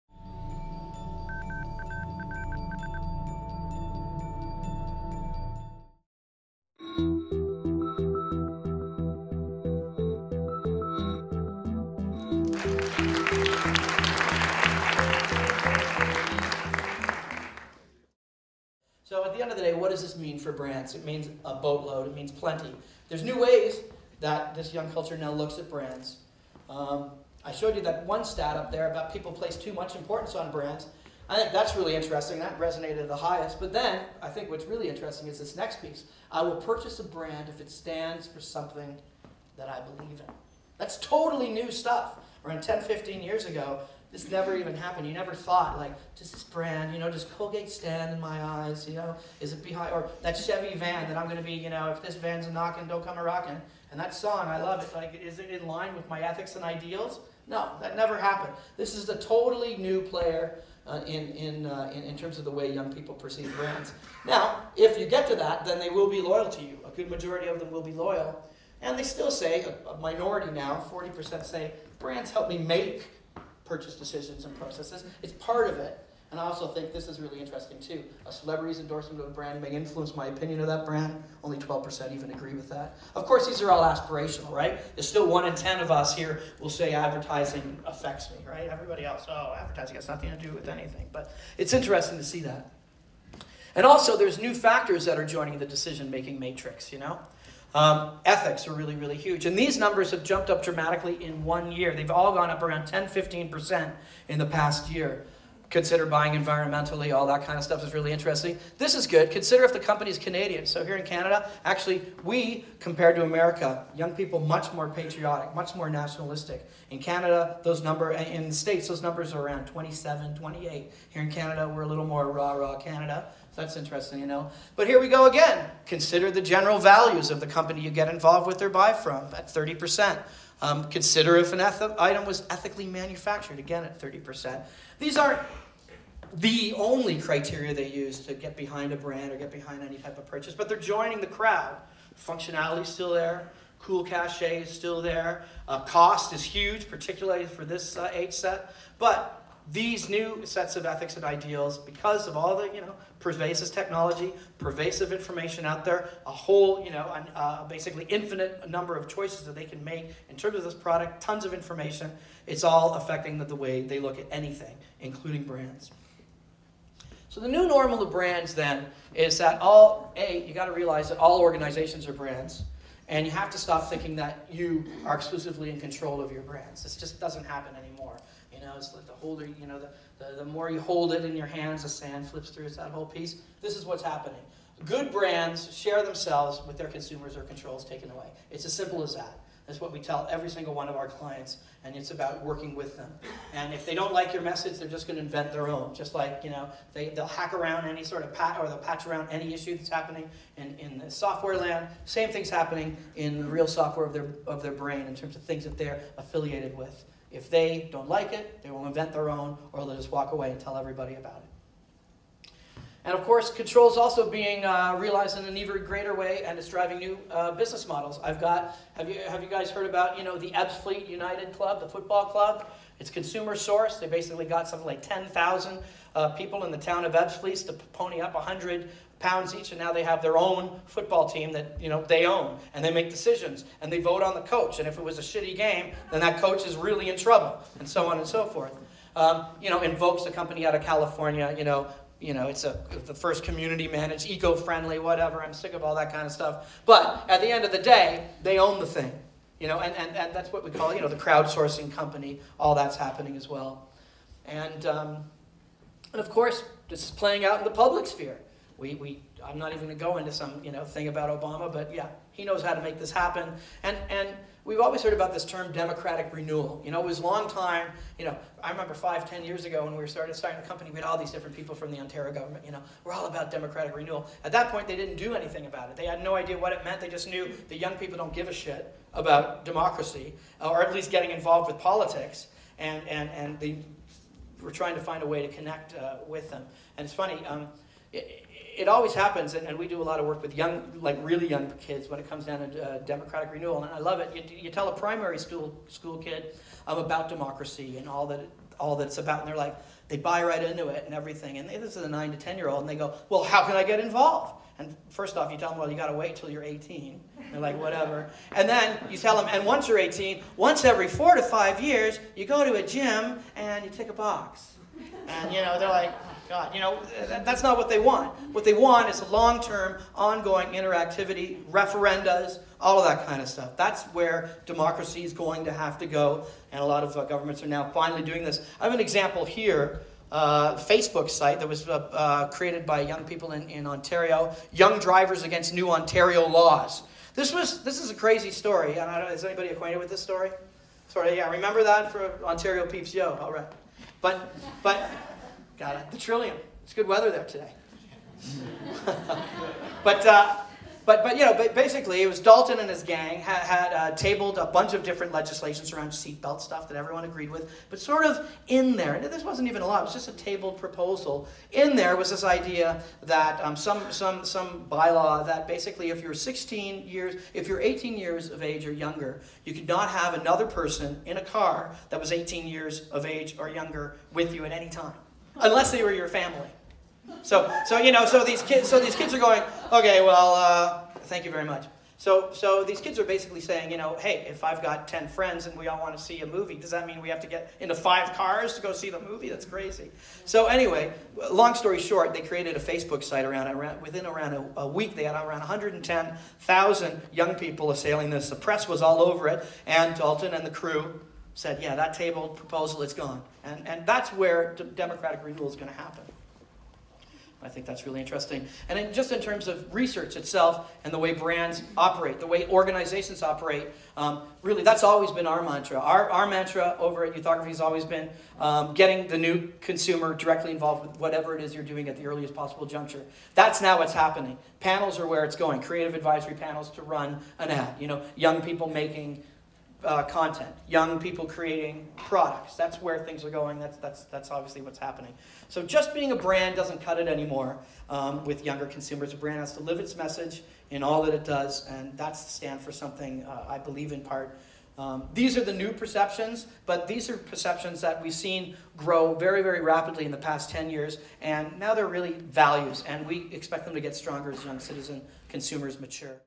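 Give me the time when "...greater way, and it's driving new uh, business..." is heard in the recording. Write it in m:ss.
3:35.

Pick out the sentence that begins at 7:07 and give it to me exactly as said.
You know, young people making uh, content, young people creating products.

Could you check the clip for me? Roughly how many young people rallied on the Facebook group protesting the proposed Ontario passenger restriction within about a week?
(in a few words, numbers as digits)
110,000.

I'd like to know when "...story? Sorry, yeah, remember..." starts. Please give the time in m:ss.
5:40.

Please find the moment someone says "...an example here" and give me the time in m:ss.
5:28.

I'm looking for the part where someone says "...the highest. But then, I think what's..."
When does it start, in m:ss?
0:33.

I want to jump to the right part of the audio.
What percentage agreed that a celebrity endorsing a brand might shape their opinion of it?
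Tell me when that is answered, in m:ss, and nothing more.
1:21.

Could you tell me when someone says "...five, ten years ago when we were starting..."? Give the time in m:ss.
4:28.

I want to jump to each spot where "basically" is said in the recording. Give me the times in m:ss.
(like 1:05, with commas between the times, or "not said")
2:37, 3:44, 5:51, 6:05, 6:23.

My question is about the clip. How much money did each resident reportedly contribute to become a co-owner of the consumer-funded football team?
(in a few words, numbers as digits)
100 pounds.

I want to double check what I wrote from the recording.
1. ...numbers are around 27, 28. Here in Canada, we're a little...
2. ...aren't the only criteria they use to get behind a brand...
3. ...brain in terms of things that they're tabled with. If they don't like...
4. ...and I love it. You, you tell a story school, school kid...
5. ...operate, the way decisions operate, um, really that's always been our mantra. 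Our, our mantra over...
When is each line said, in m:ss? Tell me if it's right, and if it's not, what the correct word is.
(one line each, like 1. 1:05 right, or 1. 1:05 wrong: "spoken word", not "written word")
1. 1:59 right
2. 2:15 right
3. 3:24 wrong: "affiliated", not "tabled"
4. 4:53 wrong: "primary", not "story"
5. 6:51 wrong: "organizations", not "decisions".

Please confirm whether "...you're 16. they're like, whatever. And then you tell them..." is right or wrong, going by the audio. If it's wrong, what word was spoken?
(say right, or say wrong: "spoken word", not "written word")
wrong: "18", not "16".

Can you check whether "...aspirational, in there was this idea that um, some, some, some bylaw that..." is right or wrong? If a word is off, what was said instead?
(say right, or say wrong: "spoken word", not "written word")
wrong: "proposal", not "aspirational".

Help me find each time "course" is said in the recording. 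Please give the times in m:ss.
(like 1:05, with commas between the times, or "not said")
1:23, 3:33, 4:16.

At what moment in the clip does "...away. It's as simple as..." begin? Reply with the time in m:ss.
3:08.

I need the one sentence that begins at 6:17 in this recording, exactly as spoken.
So, so you know, so these kids, so these kids are going, okay, well, uh, thank you very much.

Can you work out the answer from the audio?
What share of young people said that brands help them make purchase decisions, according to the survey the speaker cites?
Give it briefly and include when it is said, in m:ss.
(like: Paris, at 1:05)
40%, at 1:10.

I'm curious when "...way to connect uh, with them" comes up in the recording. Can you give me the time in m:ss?
4:45.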